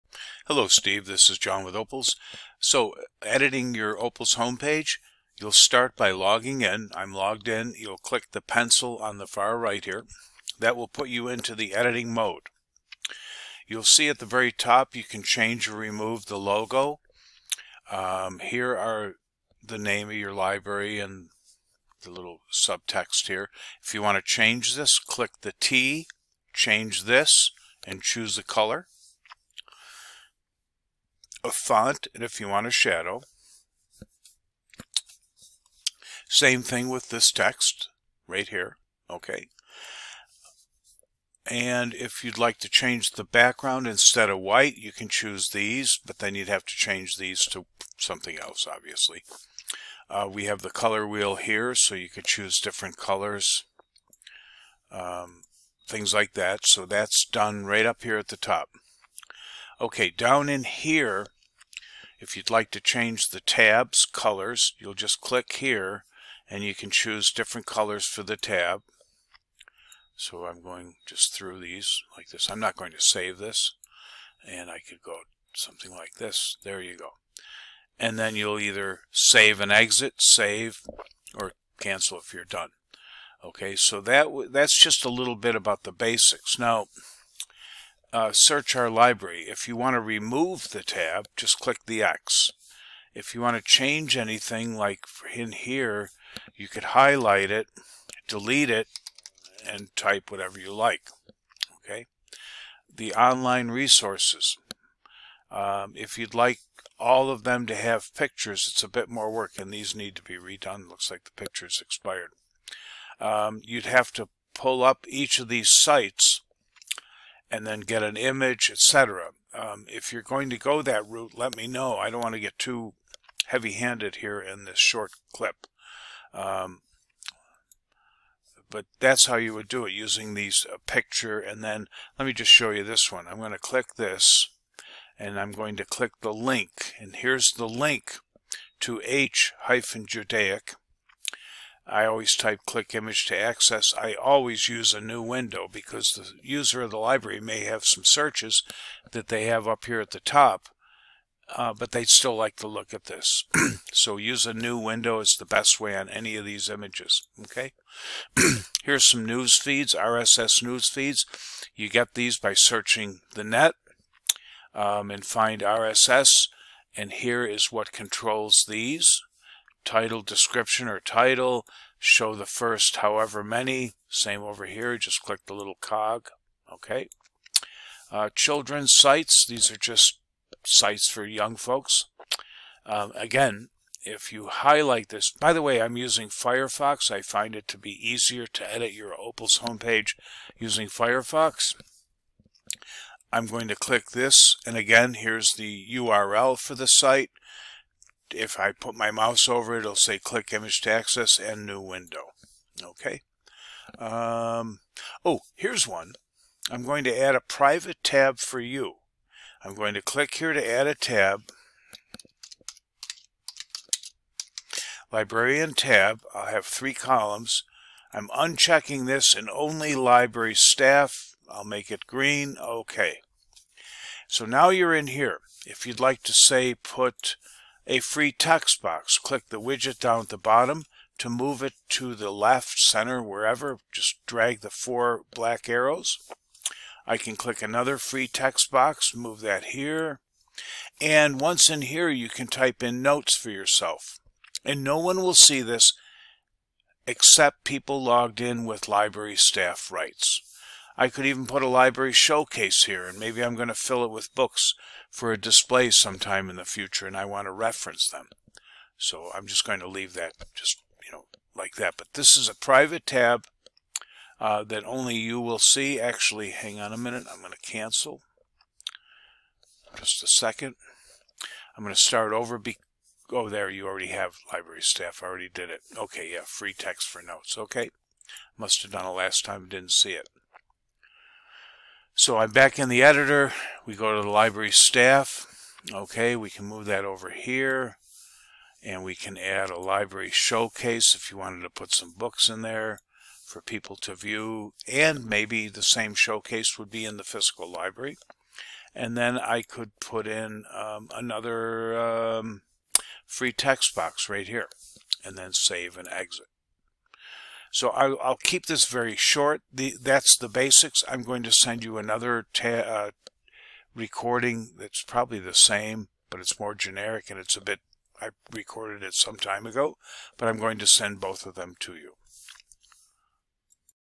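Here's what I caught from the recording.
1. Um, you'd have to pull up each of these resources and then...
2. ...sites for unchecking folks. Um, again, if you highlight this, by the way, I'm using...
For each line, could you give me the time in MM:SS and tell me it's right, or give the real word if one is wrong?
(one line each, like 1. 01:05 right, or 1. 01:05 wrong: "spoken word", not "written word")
1. 01:53 wrong: "sites", not "resources"
2. 03:00 wrong: "young", not "unchecking".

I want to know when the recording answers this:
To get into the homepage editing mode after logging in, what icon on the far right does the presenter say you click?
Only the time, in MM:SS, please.
00:08.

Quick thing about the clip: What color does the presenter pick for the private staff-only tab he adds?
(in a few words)
green.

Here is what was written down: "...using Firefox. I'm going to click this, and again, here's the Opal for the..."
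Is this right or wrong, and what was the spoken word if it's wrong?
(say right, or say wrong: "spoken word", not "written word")
wrong: "URL", not "Opal".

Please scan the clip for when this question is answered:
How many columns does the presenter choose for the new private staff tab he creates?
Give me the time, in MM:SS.
03:36.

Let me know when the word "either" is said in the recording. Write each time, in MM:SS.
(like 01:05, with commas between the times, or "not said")
01:18.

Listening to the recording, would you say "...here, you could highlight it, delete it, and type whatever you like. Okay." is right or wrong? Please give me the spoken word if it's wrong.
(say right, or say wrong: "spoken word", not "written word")
right.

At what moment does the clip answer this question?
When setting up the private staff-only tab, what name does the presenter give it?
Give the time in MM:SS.
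03:35.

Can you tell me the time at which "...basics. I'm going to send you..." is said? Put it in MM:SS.
05:10.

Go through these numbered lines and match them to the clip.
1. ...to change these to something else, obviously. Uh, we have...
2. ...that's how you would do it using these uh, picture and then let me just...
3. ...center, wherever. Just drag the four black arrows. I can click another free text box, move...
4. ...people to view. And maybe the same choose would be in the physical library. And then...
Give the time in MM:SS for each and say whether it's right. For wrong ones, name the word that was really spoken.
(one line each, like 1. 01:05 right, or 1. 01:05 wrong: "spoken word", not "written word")
1. 00:46 right
2. 02:09 right
3. 03:52 right
4. 04:53 wrong: "showcase", not "choose".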